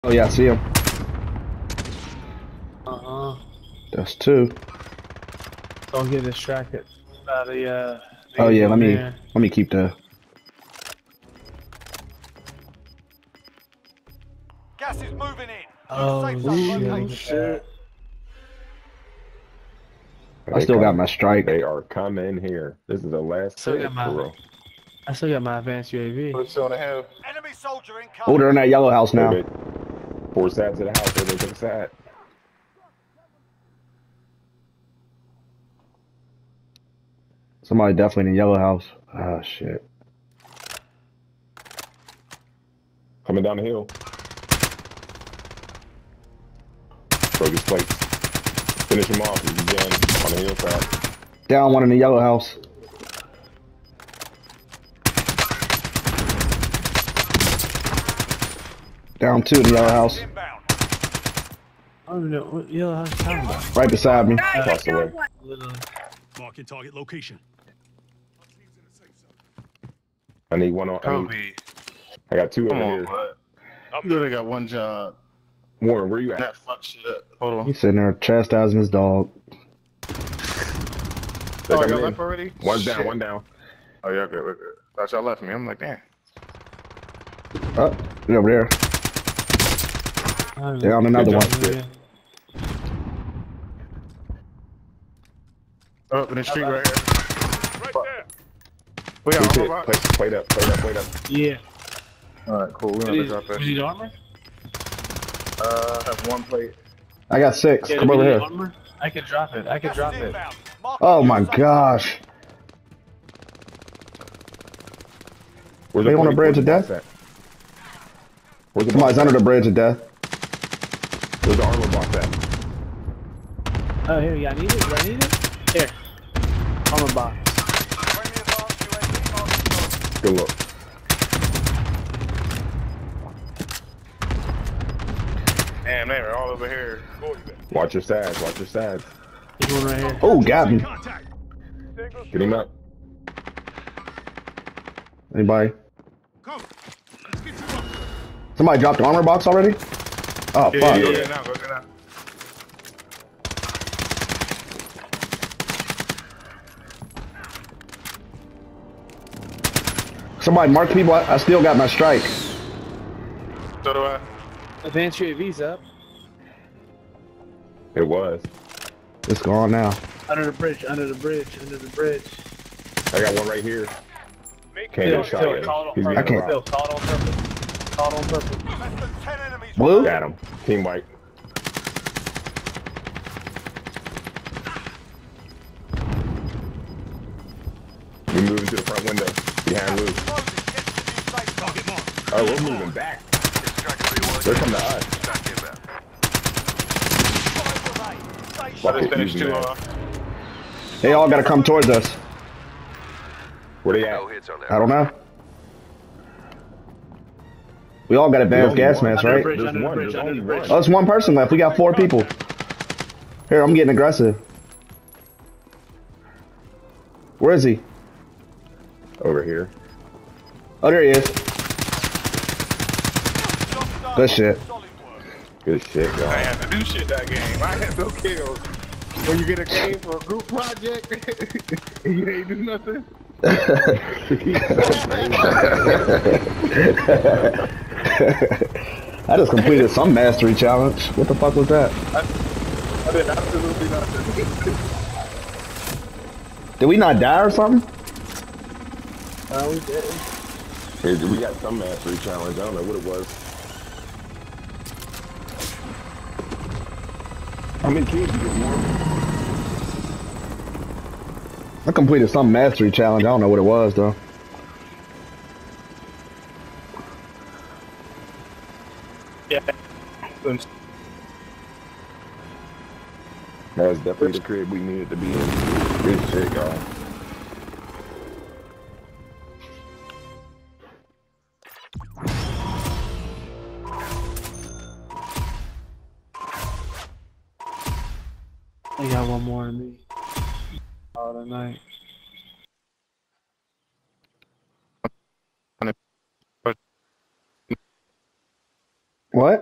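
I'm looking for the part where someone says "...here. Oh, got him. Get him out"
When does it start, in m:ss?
2:19.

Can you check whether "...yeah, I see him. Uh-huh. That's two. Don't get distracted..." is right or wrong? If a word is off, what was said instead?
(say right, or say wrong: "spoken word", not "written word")
right.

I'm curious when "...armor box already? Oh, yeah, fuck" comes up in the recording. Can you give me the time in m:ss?
2:29.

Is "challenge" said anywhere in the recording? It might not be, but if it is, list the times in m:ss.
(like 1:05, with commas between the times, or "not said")
4:00, 4:12, 4:22.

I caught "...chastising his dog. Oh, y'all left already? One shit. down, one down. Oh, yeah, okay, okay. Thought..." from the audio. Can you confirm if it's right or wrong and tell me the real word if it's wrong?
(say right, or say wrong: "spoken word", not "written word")
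right.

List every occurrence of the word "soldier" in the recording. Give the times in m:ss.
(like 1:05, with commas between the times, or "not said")
0:27.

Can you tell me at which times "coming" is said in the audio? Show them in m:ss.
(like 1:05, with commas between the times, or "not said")
0:21, 0:43, 3:14.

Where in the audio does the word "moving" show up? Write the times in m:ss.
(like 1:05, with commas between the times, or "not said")
0:15, 3:08, 3:12.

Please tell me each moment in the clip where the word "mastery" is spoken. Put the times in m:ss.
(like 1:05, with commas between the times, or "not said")
4:00, 4:11, 4:22.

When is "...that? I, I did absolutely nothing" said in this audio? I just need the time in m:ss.
4:01.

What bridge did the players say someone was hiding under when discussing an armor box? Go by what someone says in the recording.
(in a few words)
Bridge of death.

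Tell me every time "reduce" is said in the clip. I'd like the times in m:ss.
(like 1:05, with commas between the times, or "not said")
not said.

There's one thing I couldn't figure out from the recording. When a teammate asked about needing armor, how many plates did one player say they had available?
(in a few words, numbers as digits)
6.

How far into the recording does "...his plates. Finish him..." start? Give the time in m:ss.
0:47.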